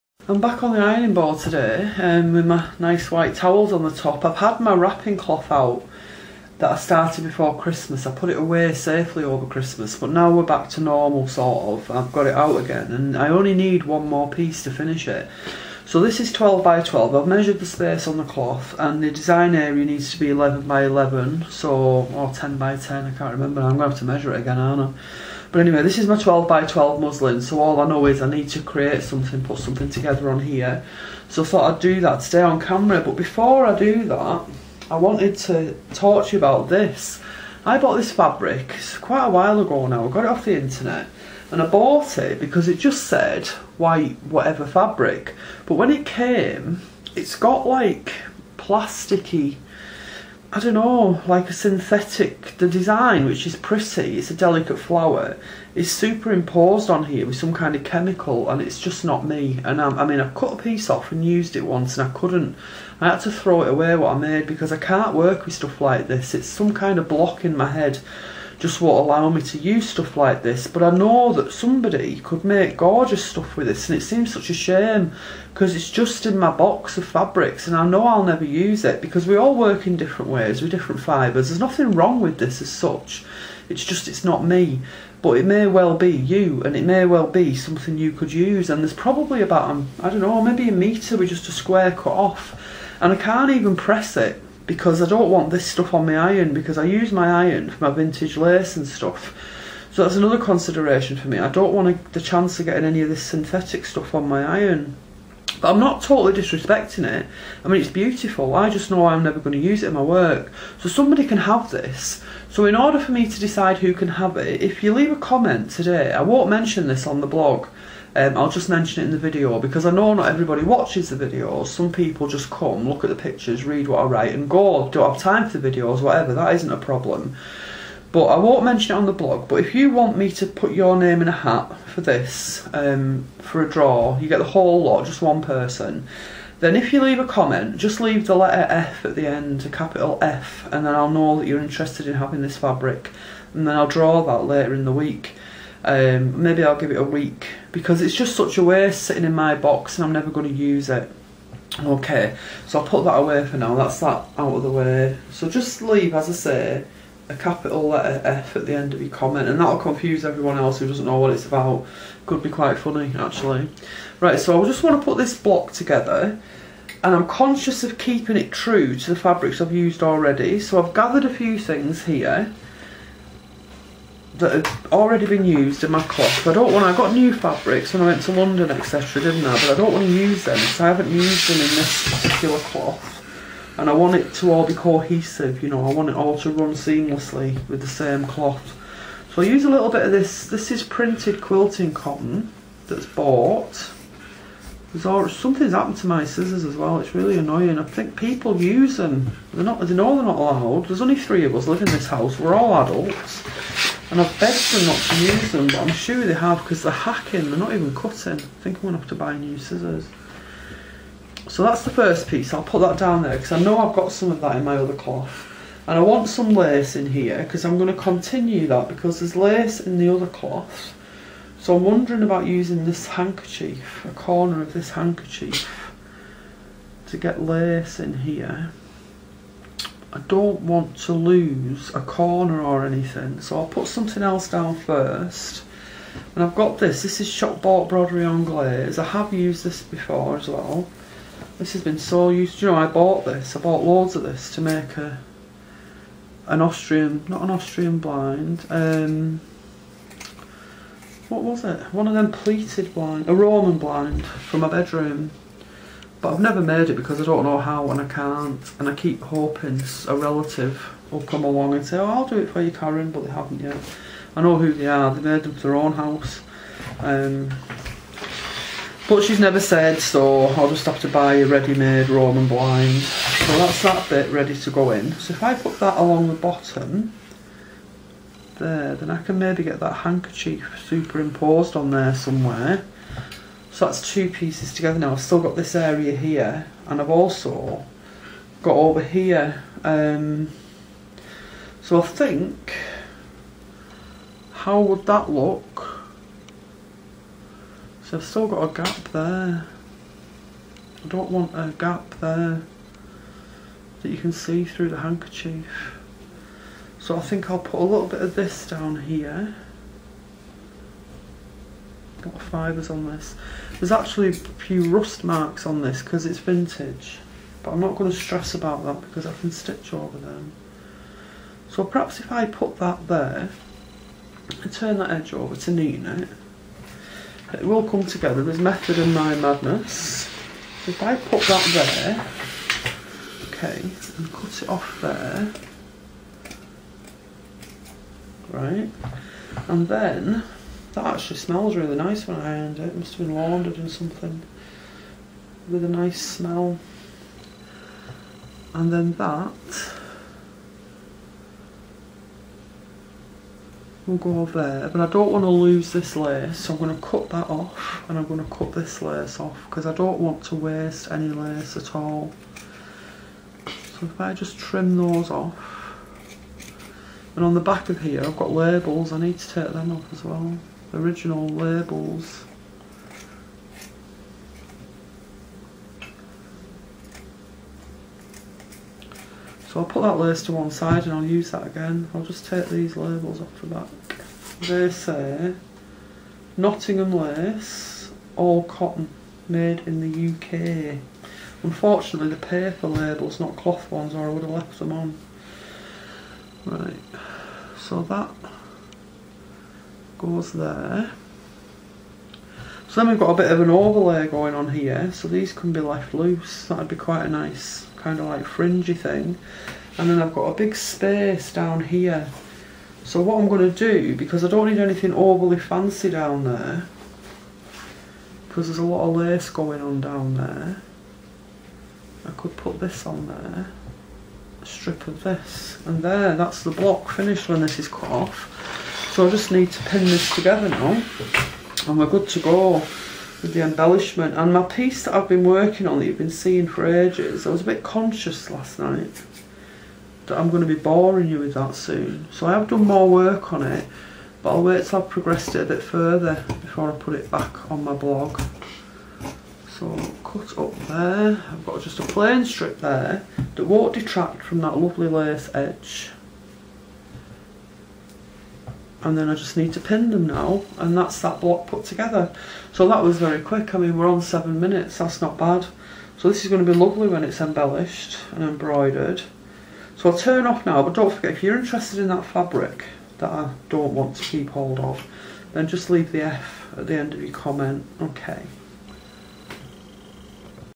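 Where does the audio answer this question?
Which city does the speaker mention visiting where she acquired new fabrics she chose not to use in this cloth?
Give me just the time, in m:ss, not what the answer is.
2:58.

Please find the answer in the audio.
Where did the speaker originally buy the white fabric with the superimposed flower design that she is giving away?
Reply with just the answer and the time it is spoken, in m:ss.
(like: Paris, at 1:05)
the internet, at 0:40.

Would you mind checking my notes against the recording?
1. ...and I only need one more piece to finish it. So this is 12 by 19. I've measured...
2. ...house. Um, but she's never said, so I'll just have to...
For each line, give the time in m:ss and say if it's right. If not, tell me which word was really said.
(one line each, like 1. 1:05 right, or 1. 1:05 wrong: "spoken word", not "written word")
1. 0:12 wrong: "12", not "19"
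2. 4:25 right.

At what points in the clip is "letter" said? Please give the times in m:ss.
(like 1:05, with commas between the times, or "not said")
2:18, 2:37.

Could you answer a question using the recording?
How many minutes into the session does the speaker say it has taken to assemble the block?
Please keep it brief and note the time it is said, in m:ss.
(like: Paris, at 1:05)
7, at 7:44.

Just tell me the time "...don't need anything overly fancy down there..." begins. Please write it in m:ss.
6:54.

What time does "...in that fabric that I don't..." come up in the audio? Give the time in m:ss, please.
7:51.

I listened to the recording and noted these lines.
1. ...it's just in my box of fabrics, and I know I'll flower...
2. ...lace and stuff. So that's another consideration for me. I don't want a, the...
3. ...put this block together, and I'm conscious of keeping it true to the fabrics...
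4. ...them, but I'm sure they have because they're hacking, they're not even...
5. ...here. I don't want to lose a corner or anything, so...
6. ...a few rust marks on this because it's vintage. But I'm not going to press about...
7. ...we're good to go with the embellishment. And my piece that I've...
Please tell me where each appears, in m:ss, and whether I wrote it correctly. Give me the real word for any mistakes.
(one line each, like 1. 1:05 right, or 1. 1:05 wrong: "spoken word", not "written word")
1. 1:15 wrong: "never", not "flower"
2. 1:38 right
3. 2:45 right
4. 3:25 right
5. 3:48 right
6. 5:14 wrong: "stress", not "press"
7. 7:11 right.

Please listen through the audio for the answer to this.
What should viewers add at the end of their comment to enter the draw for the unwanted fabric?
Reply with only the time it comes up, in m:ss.
2:19.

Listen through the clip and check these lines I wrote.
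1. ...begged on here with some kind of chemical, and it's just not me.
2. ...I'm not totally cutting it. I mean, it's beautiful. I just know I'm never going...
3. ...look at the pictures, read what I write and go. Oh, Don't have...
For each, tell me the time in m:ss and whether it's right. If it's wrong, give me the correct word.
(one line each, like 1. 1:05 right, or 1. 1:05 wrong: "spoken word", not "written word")
1. 0:55 wrong: "superimposed", not "begged"
2. 1:45 wrong: "disrespecting", not "cutting"
3. 2:02 right.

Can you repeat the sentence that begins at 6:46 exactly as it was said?
That'd be quite a nice kind of like fringy thing.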